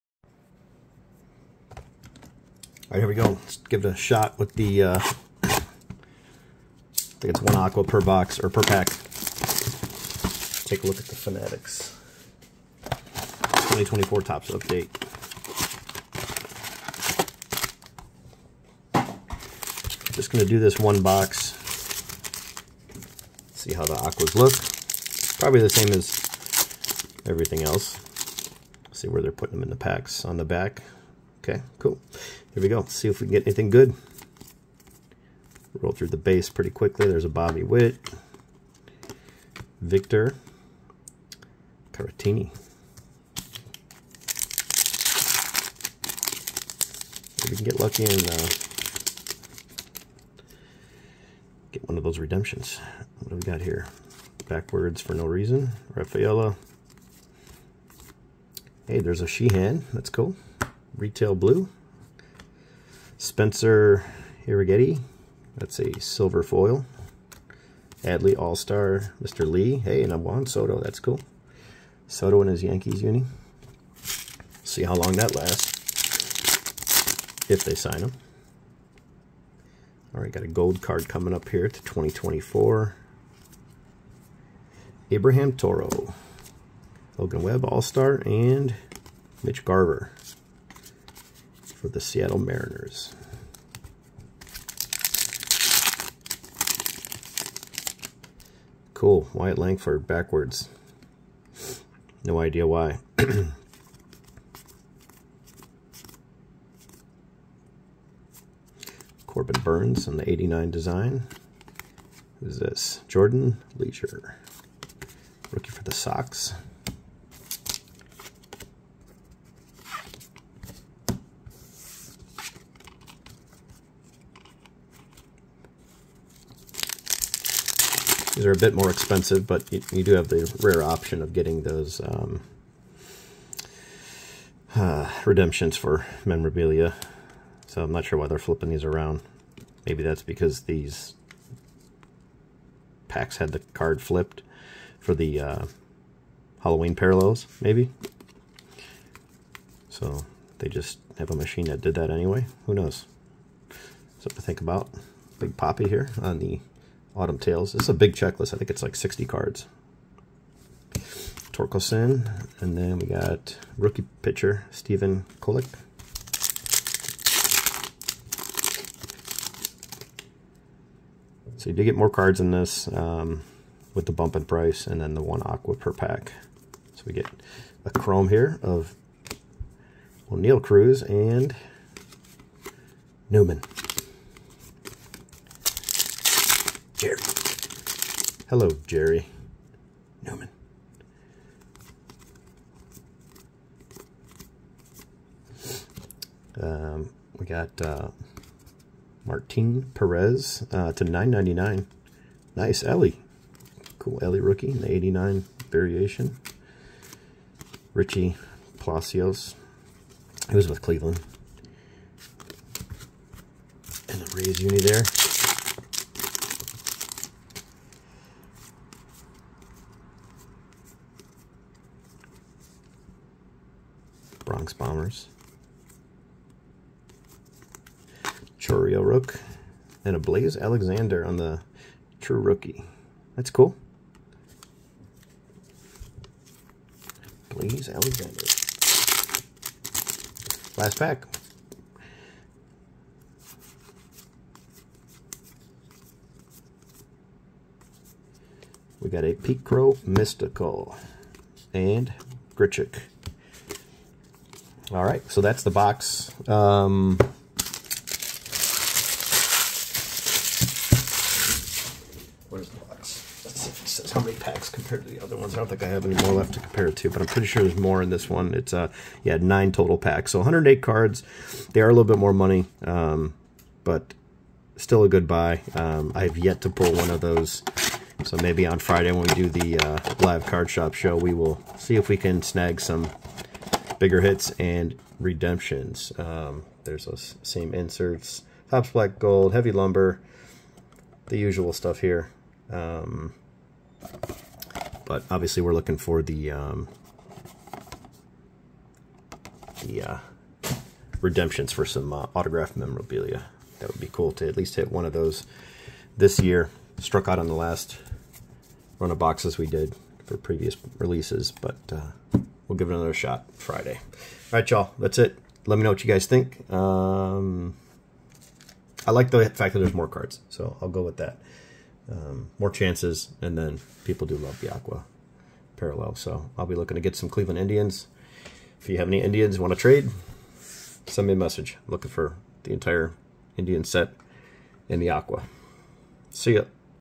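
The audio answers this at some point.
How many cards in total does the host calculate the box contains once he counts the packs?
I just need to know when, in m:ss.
4:30.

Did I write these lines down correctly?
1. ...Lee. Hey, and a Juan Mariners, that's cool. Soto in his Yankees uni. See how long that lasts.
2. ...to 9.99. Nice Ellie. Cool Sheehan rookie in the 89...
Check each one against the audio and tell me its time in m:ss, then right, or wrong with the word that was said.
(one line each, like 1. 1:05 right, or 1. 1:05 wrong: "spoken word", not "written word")
1. 1:09 wrong: "Soto", not "Mariners"
2. 3:20 wrong: "Ellie", not "Sheehan".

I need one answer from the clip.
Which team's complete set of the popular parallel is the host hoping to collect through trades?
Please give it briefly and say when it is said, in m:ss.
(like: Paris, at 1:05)
Cleveland Indians, at 5:27.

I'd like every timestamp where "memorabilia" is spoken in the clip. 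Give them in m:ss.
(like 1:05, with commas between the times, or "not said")
2:16, 5:02.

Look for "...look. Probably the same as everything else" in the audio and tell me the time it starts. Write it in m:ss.
0:24.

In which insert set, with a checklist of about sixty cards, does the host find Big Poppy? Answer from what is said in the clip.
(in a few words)
Autumn Tales.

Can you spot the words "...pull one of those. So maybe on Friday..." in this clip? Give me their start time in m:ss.
4:36.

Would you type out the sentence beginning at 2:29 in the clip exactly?
So they just have a machine that did that anyway.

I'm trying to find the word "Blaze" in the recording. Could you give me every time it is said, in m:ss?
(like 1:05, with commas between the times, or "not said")
3:50, 3:57.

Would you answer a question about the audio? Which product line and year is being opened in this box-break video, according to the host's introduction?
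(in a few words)
2024 Topps update.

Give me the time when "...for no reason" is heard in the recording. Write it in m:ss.
0:55.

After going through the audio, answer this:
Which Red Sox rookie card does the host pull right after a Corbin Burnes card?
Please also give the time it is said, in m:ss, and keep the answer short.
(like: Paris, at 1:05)
Jordan Leisure, at 1:53.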